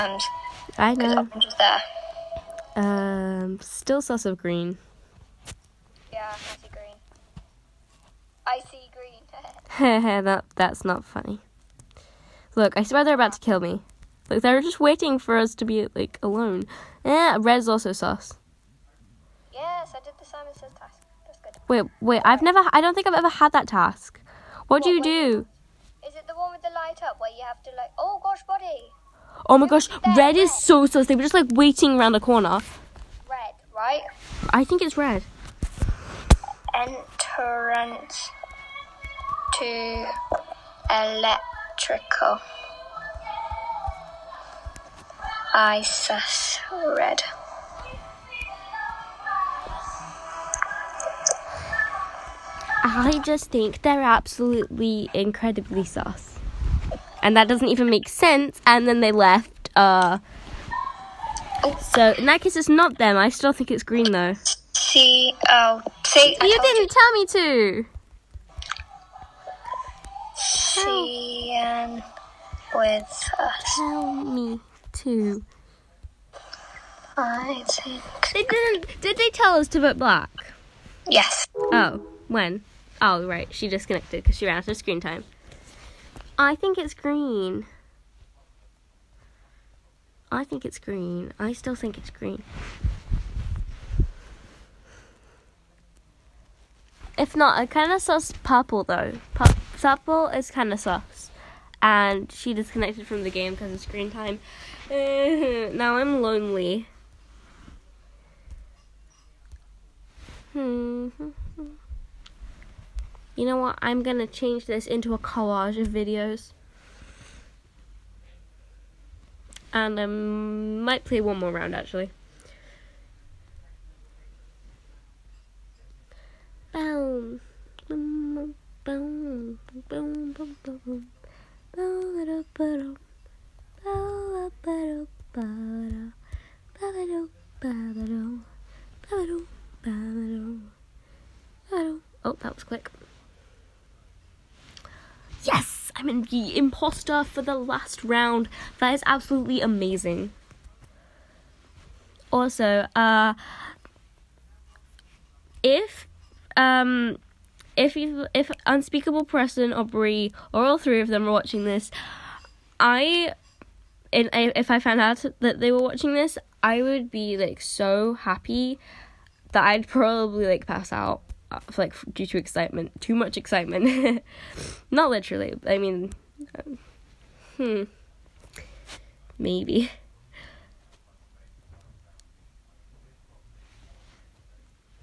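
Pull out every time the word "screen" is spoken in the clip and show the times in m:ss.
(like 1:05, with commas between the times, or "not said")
1:24, 1:43.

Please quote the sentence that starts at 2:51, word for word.
Uh, like due to excitement, too much excitement.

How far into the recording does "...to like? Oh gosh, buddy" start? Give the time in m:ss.
0:27.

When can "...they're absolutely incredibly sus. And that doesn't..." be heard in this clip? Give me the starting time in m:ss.
0:53.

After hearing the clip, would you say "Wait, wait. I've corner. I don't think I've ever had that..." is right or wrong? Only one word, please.
wrong.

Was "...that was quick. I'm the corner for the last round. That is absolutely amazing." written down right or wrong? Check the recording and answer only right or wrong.
wrong.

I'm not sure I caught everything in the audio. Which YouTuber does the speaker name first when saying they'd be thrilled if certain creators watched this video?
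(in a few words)
Unspeakable.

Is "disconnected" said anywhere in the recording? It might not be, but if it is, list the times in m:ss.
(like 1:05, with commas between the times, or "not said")
1:23, 1:42.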